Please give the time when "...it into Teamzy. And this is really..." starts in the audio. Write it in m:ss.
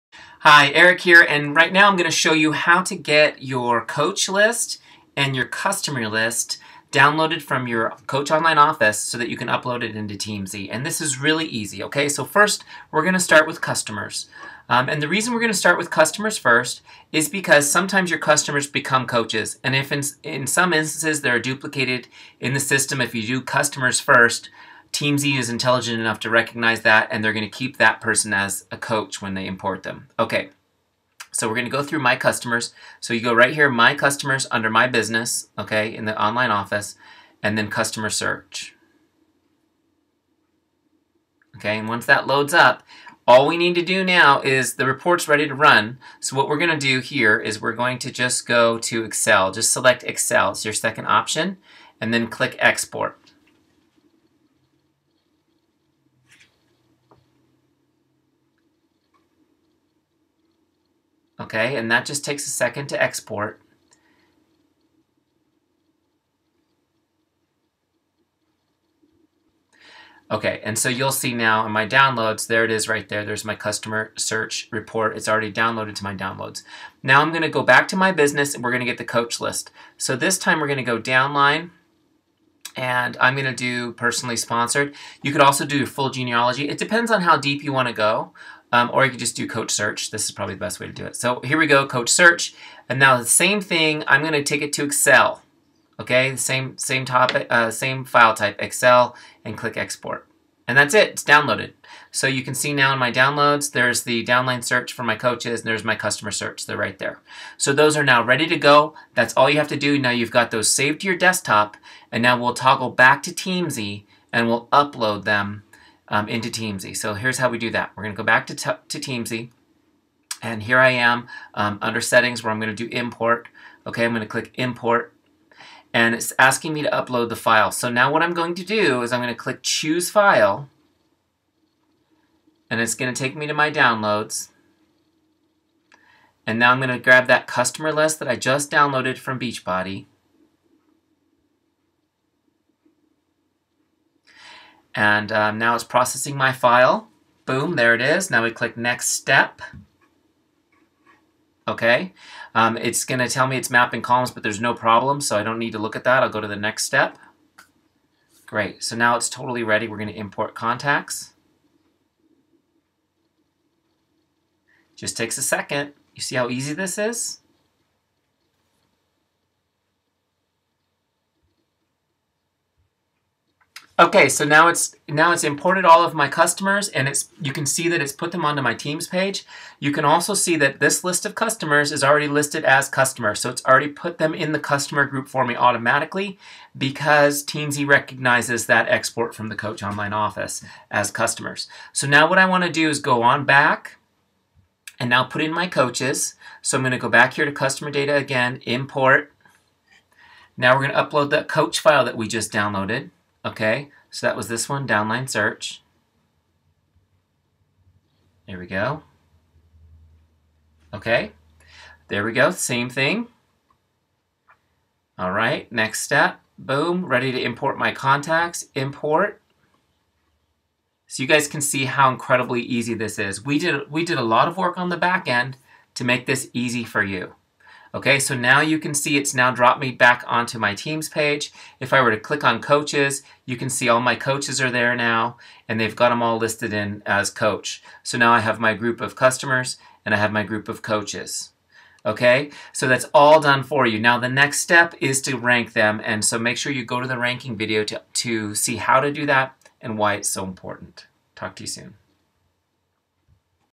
0:09.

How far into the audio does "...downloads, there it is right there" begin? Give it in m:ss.
1:11.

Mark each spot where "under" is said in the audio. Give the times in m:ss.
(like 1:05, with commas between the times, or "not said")
0:34, 2:01.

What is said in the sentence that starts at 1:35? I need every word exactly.
Okay, the same, same, topic, uh, same file type, Excel, and click export.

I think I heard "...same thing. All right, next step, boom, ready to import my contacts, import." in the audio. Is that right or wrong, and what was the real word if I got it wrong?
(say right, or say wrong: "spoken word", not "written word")
right.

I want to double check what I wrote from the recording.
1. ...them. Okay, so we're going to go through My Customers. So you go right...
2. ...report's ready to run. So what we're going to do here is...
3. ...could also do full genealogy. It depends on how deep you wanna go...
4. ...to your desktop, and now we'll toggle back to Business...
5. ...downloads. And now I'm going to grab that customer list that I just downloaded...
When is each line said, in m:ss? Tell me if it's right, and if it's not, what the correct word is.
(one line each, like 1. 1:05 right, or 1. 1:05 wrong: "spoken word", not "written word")
1. 0:29 right
2. 0:44 right
3. 1:25 right
4. 1:51 wrong: "Teamzy", not "Business"
5. 2:13 right.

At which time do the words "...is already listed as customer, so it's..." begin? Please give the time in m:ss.
3:01.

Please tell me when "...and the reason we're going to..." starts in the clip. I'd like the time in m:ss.
0:14.